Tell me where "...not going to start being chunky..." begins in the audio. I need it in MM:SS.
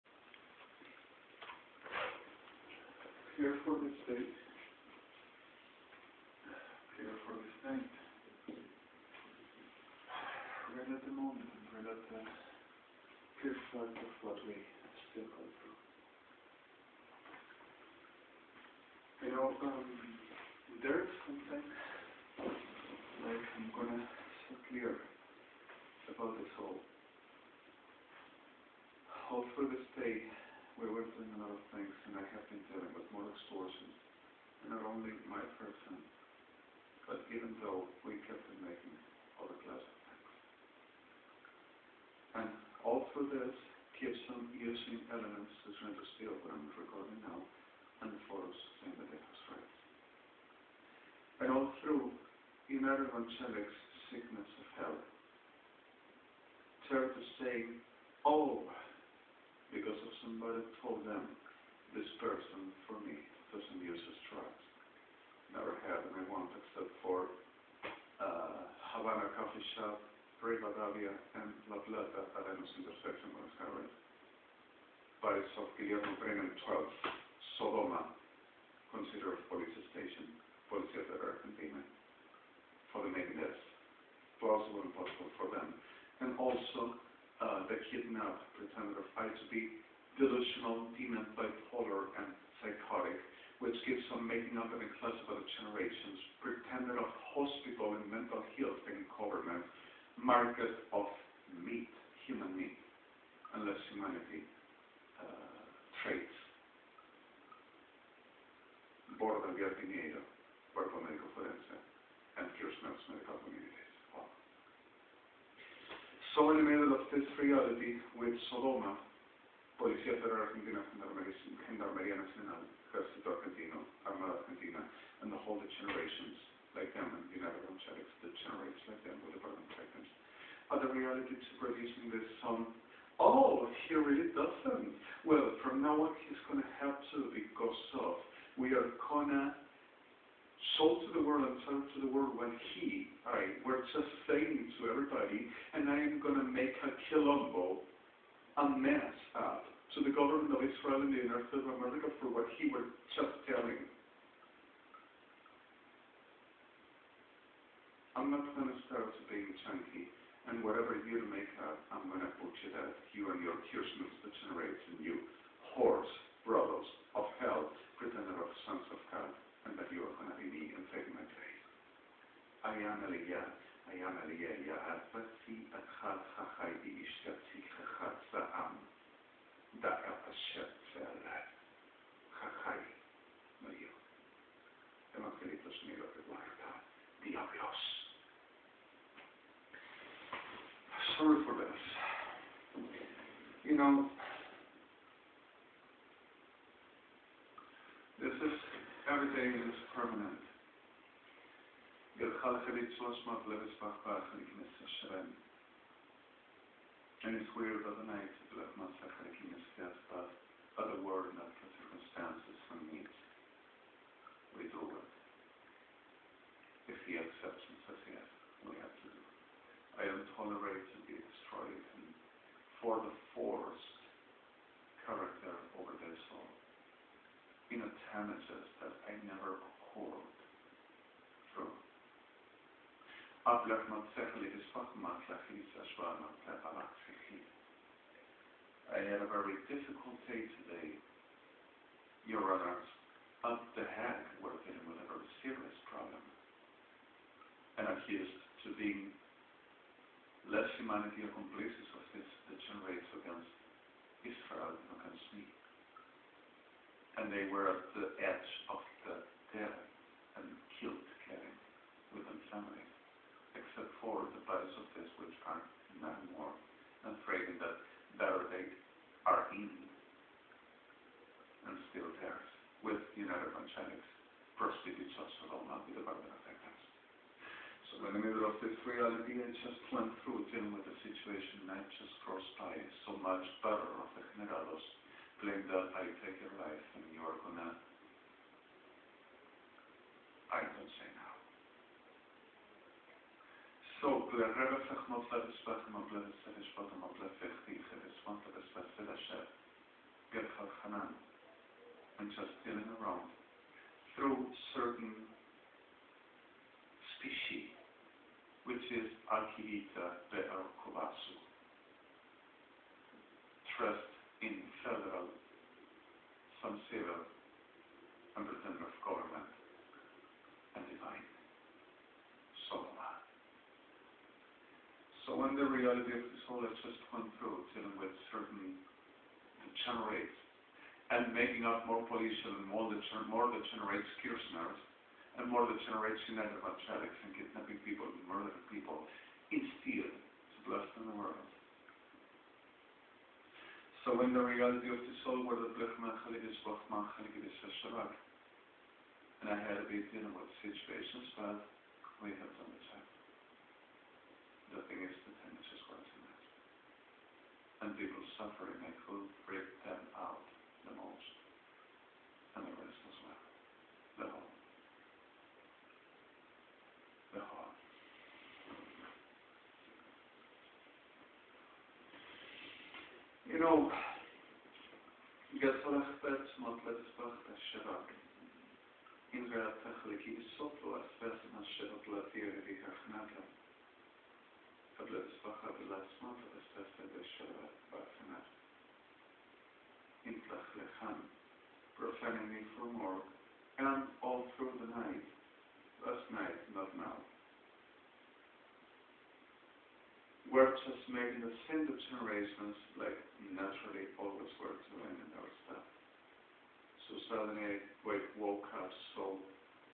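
02:38.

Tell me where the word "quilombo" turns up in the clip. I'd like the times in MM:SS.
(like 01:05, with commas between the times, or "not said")
02:27.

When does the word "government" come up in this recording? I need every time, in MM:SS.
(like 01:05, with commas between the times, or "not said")
01:39, 02:30, 05:19.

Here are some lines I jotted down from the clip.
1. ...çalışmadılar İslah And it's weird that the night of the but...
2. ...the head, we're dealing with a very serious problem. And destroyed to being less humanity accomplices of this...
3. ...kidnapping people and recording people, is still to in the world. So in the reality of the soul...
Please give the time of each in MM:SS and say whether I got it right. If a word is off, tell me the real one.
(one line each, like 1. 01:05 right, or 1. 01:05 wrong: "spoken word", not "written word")
1. 03:22 right
2. 04:03 wrong: "accused", not "destroyed"
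3. 05:37 wrong: "murdering", not "recording".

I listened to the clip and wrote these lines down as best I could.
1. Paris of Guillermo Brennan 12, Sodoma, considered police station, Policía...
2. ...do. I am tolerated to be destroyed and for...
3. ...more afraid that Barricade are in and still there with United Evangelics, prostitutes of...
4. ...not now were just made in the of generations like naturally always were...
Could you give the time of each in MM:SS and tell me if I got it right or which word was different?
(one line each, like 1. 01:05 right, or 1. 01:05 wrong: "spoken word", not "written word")
1. 01:15 right
2. 03:39 right
3. 04:26 right
4. 06:36 right.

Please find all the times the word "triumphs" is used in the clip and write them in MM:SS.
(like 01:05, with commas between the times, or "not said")
not said.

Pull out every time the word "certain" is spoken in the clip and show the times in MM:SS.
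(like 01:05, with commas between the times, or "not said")
05:04, 05:28.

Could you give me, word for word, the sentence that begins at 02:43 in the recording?
you and your kirsmans, the generation, you horse, brother.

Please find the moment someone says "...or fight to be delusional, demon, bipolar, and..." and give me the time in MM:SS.
01:28.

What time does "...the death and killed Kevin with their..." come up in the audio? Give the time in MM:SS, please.
04:19.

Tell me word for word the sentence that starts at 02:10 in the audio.
Other reality to producing this song, oh, he really doesn't.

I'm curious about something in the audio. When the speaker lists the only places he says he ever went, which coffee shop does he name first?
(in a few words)
Havana Coffee Shop.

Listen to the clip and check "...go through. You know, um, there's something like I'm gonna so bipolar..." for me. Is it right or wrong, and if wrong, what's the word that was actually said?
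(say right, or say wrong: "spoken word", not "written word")
wrong: "clear", not "bipolar".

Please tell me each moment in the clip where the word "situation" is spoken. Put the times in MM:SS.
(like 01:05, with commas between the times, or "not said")
04:41, 05:50.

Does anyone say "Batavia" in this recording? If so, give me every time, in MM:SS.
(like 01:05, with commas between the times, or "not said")
01:10.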